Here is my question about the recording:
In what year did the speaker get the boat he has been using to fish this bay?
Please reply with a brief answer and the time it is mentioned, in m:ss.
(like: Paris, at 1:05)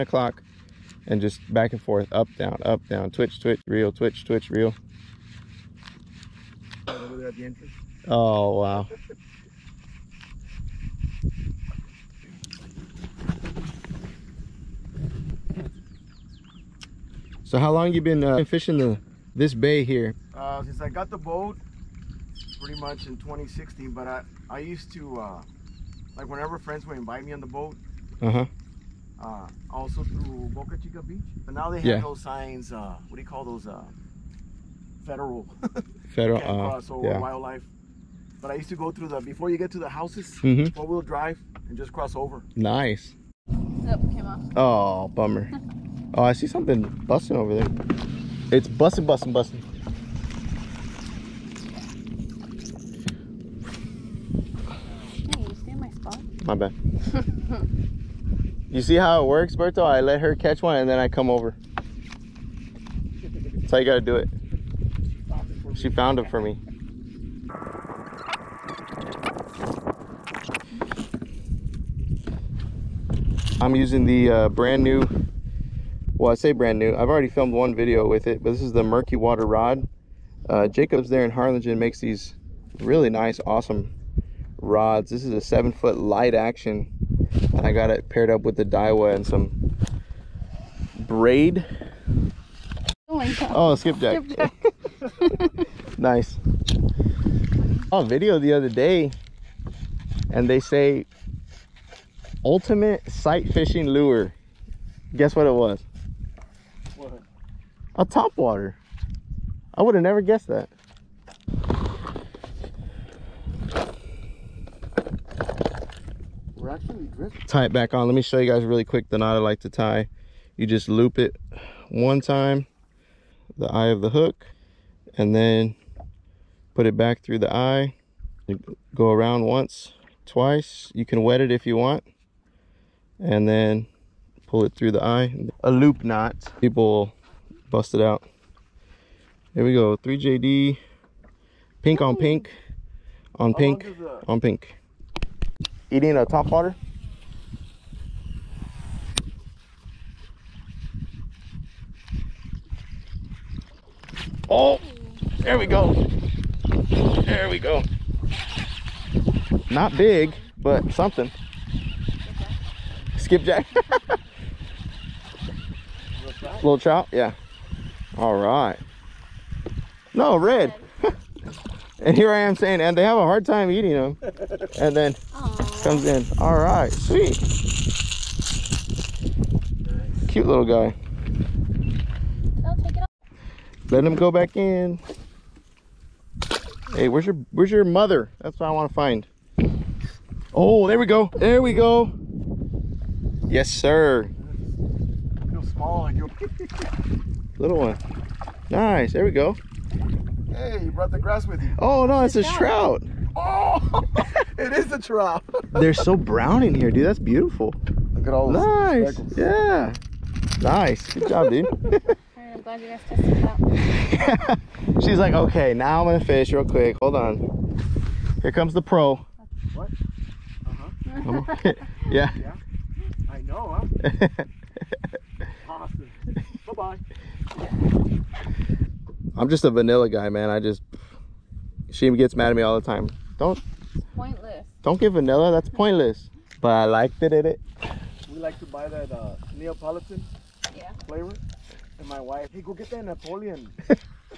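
2016, at 0:23.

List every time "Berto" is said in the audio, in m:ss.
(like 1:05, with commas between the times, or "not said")
0:59.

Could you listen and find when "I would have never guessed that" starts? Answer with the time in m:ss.
1:49.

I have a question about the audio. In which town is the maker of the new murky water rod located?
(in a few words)
Harlingen.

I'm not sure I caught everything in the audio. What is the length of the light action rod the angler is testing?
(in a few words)
7 foot.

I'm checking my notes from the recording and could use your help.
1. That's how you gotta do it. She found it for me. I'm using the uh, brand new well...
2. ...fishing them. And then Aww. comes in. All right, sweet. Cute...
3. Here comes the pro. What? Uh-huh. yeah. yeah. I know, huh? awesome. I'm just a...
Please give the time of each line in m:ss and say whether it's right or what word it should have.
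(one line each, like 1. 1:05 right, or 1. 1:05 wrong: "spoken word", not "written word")
1. 1:03 right
2. 2:53 wrong: "eating", not "fishing"
3. 3:38 right.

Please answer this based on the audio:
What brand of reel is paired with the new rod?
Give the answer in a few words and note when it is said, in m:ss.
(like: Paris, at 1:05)
Daiwa, at 1:28.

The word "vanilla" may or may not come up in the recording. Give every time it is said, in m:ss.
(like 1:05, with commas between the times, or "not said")
3:49, 3:55.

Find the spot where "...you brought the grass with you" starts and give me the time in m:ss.
3:20.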